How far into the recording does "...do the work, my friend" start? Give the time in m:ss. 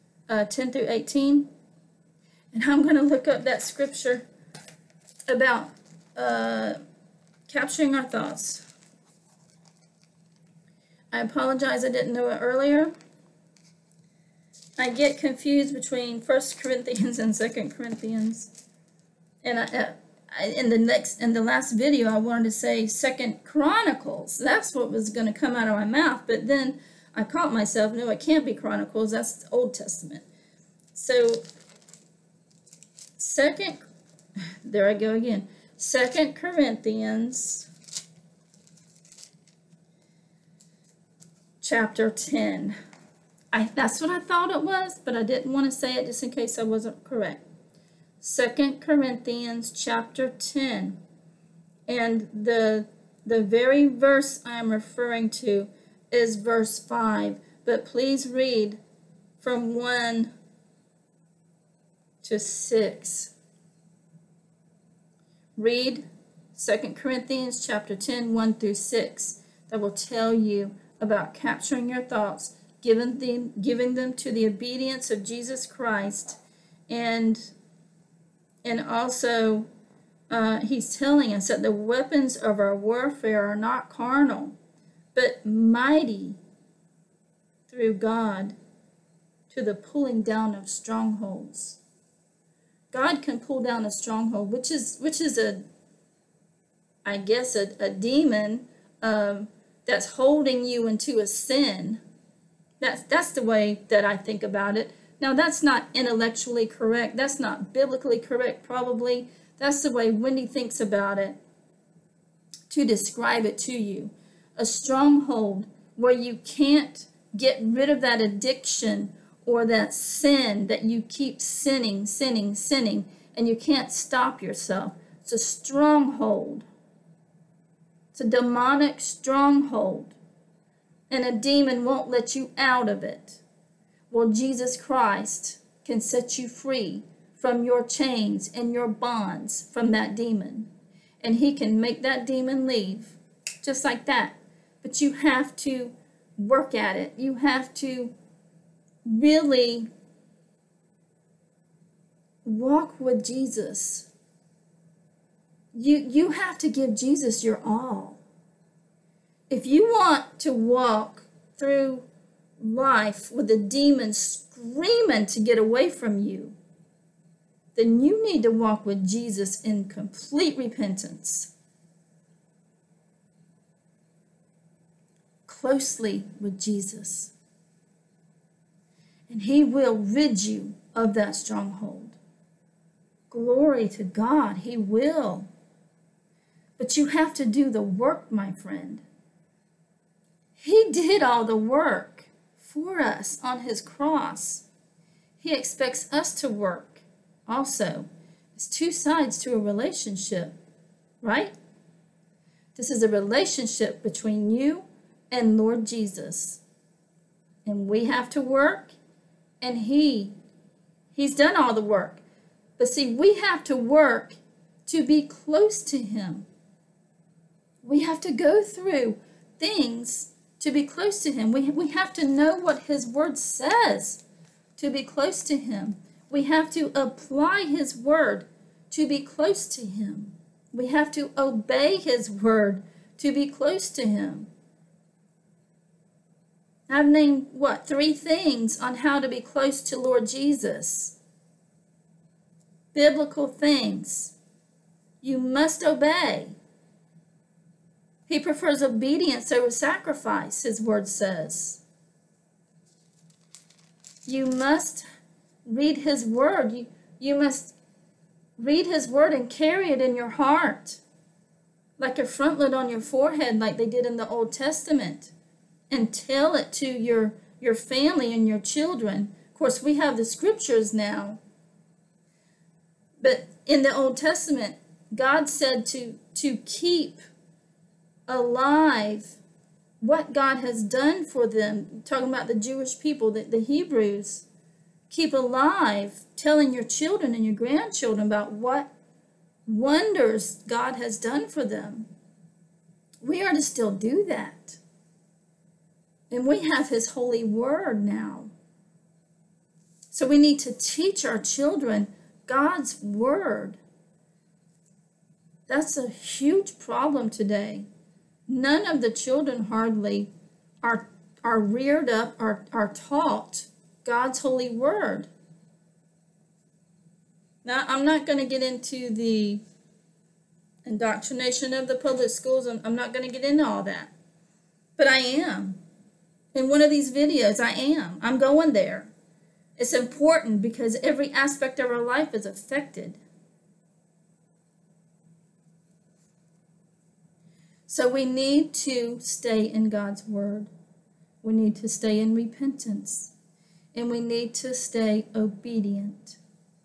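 3:07.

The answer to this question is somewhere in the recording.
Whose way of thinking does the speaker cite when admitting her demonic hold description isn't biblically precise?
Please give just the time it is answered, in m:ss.
1:50.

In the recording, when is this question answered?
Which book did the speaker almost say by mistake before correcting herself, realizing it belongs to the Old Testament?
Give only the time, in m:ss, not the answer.
0:22.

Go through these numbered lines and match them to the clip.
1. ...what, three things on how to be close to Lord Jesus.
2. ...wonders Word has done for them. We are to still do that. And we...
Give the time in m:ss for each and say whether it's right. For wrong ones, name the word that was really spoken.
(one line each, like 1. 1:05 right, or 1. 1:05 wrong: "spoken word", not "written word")
1. 3:57 right
2. 4:49 wrong: "God", not "Word".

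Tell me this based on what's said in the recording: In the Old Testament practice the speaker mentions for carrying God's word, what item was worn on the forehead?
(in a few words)
frontlet.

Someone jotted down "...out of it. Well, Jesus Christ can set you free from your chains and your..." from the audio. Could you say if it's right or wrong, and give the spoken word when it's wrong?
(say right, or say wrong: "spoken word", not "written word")
right.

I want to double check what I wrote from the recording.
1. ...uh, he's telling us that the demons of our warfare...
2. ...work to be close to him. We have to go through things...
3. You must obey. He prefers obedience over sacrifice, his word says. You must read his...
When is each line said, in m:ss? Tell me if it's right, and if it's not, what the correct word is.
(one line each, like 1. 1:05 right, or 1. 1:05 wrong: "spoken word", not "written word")
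1. 1:20 wrong: "weapons", not "demons"
2. 3:33 right
3. 4:05 right.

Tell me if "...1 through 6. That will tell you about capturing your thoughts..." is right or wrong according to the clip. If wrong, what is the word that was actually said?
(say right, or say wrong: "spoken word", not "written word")
right.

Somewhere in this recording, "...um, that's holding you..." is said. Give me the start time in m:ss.
1:39.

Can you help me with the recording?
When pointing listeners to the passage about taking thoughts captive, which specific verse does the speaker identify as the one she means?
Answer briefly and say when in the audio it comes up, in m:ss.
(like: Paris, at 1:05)
verse 5, at 0:56.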